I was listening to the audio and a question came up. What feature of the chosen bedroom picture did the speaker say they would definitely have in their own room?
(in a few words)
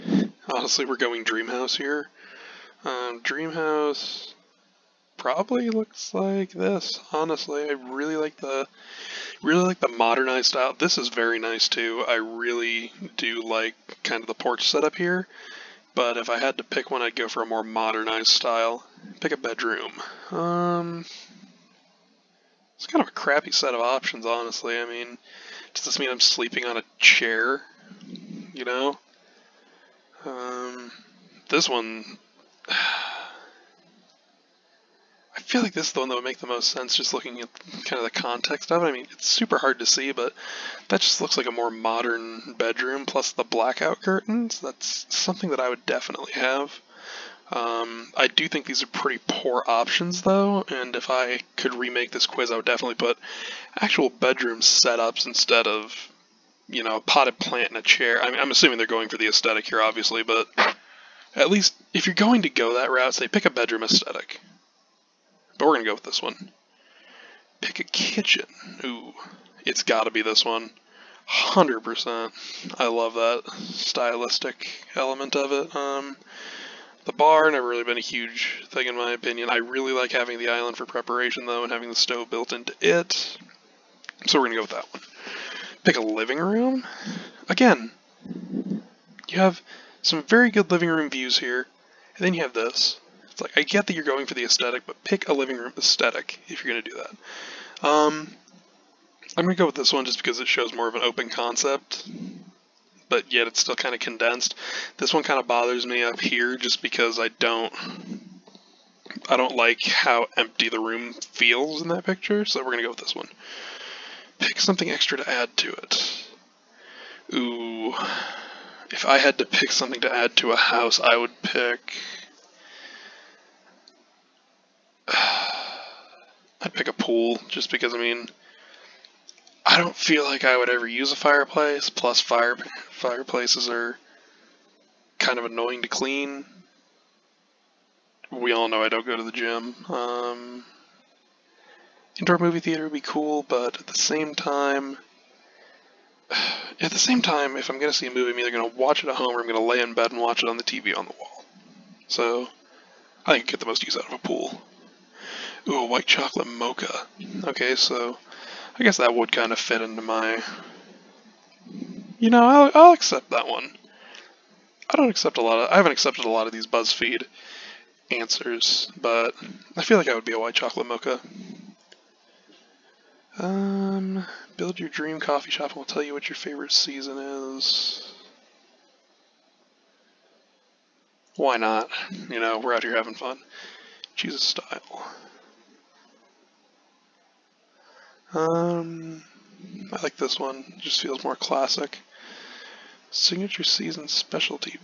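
Blackout curtains.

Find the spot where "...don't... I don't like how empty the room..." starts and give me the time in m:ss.
1:47.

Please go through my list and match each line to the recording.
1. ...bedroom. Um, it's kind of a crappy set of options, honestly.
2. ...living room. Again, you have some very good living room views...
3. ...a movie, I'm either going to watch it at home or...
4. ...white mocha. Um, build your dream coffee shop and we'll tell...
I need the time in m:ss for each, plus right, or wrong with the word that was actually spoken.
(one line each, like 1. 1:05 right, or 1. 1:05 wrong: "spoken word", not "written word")
1. 0:19 right
2. 1:26 right
3. 2:28 right
4. 2:50 wrong: "chocolate", not "white".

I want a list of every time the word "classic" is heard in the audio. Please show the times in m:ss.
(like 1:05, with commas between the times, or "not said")
3:11.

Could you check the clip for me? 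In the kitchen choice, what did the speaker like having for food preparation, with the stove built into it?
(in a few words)
The island.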